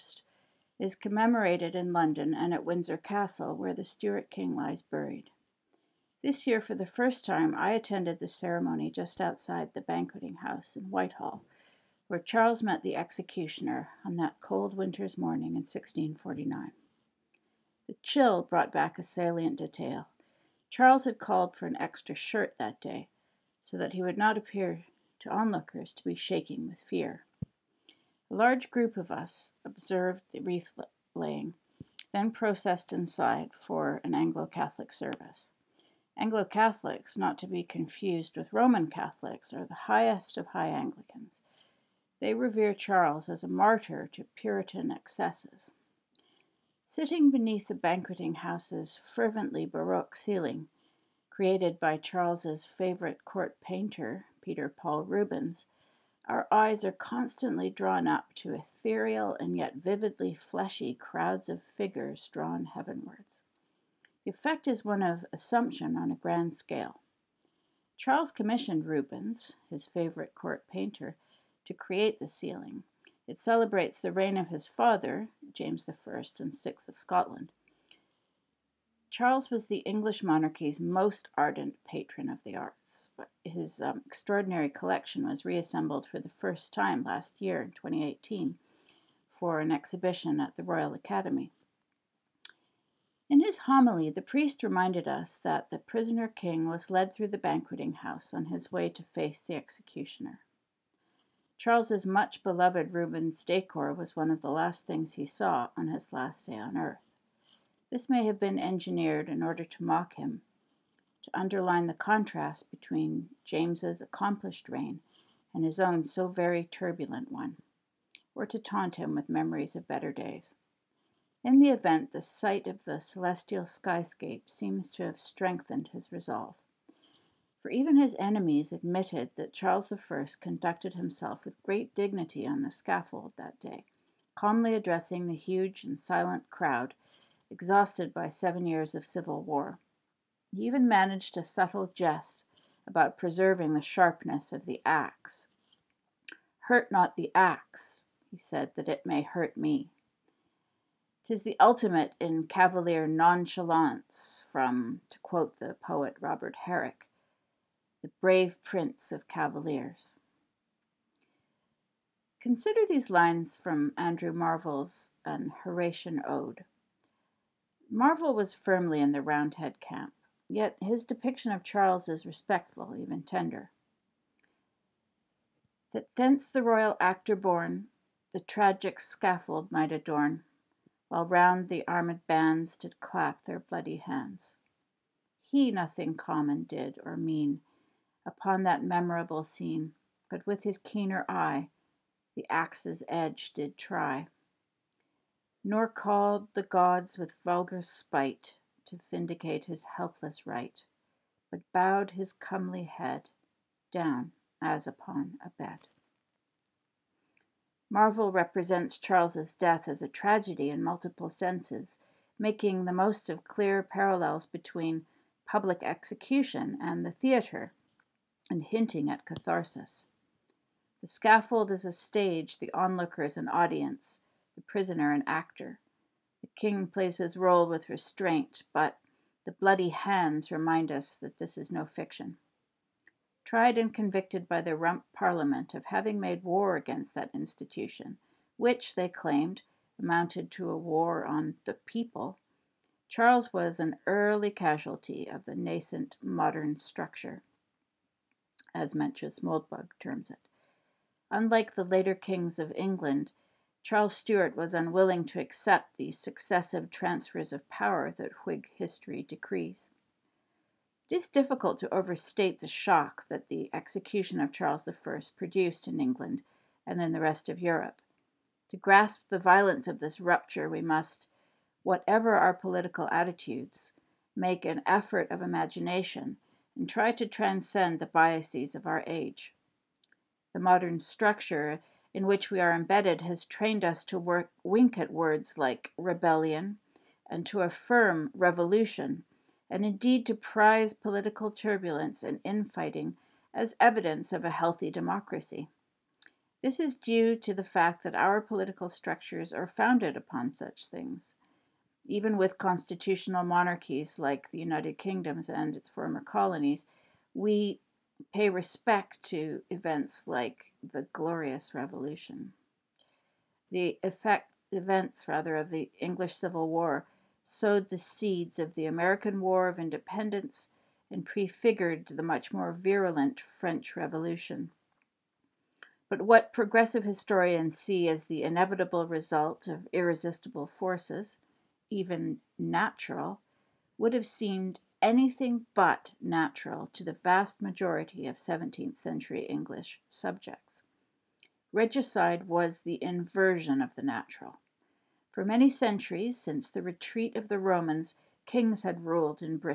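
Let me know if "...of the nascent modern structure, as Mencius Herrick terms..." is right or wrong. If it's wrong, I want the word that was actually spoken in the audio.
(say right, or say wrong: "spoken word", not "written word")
wrong: "Moldbug", not "Herrick".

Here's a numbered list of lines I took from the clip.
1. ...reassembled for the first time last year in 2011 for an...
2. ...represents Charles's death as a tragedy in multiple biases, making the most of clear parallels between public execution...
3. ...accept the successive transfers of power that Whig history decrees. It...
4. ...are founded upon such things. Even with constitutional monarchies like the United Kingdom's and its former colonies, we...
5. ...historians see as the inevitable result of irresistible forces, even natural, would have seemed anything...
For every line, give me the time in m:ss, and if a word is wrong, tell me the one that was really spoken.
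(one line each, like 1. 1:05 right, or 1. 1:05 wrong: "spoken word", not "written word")
1. 1:25 wrong: "2018", not "2011"
2. 3:28 wrong: "senses", not "biases"
3. 4:15 right
4. 4:59 right
5. 5:27 right.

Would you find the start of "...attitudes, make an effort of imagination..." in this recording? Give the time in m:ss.
4:33.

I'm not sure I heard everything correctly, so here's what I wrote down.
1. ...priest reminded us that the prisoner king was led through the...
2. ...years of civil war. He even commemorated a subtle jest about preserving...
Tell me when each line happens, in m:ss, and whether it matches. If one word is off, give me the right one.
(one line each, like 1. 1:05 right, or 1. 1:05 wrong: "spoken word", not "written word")
1. 1:34 right
2. 2:18 wrong: "managed", not "commemorated".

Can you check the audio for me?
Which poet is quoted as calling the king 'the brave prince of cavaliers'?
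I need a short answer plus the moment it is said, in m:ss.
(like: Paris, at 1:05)
Robert Herrick, at 2:36.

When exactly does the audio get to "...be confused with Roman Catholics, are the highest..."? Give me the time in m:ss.
0:37.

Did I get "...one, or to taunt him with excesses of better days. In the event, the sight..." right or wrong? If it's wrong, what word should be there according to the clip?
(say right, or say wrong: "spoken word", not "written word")
wrong: "memories", not "excesses".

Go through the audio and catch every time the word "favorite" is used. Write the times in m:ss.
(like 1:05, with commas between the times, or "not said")
0:52, 1:09.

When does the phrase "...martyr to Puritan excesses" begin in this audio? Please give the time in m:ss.
0:43.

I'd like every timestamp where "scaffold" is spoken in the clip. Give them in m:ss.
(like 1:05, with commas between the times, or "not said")
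2:12, 2:59, 3:41.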